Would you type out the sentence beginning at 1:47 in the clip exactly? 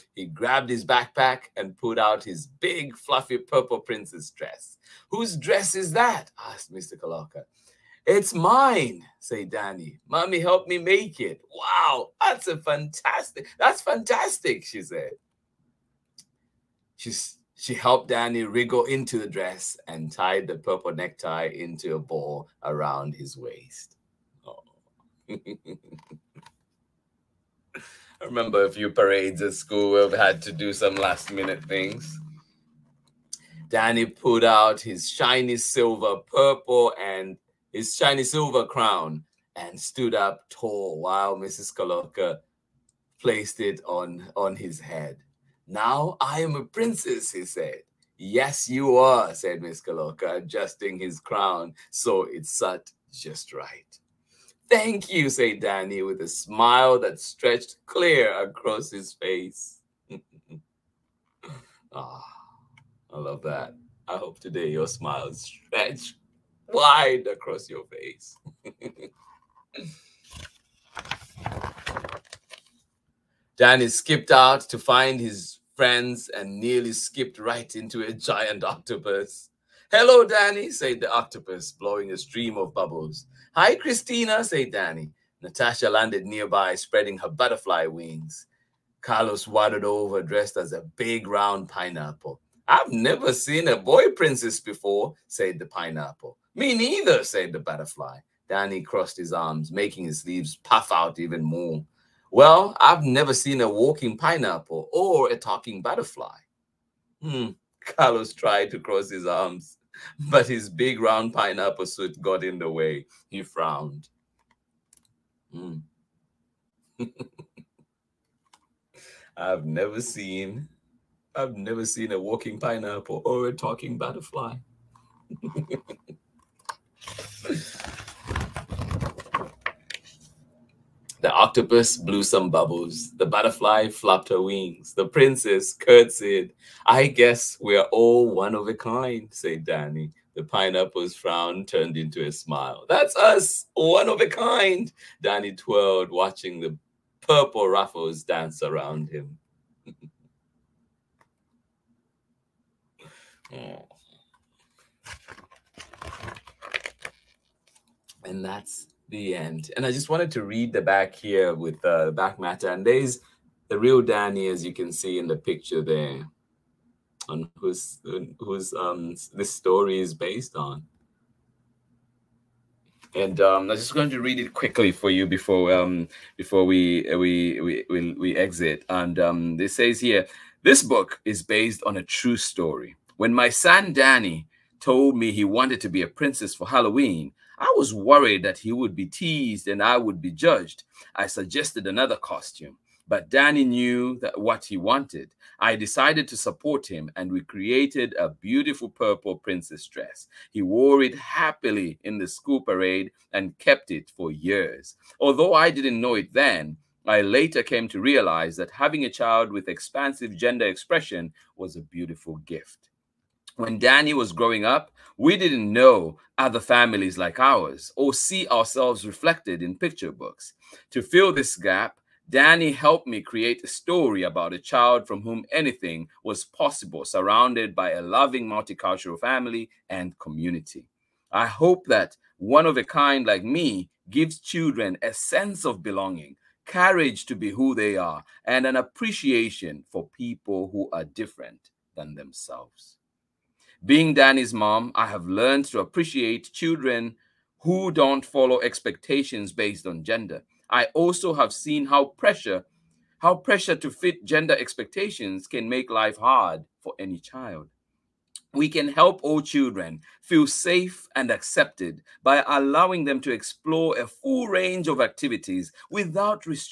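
Hmm, Carlos tried to cross his arms, but his big round pineapple suit got in the way.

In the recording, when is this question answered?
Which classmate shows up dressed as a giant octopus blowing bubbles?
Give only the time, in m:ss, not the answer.
1:23.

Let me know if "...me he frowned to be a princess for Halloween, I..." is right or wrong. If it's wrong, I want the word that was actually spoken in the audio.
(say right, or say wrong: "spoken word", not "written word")
wrong: "wanted", not "frowned".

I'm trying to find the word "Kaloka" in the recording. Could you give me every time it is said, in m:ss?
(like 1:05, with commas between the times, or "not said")
0:41, 0:49.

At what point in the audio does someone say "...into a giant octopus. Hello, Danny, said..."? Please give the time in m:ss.
1:17.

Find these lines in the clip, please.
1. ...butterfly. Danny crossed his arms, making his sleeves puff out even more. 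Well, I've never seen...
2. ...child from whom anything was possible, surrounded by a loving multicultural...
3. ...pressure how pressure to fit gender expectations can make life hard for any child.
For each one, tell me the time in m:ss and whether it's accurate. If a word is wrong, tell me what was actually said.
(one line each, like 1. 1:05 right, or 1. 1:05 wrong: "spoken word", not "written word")
1. 1:37 right
2. 3:44 right
3. 4:12 right.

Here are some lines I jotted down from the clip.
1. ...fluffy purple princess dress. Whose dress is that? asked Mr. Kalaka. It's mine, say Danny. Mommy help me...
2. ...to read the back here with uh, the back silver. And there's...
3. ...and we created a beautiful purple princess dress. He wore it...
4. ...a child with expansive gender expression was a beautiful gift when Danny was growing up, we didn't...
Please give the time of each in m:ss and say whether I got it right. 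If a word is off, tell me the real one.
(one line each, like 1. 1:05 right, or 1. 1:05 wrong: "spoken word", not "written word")
1. 0:02 right
2. 2:40 wrong: "matter", not "silver"
3. 3:17 right
4. 3:29 right.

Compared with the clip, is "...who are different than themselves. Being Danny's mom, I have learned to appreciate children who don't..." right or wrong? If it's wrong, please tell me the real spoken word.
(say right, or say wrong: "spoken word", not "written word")
right.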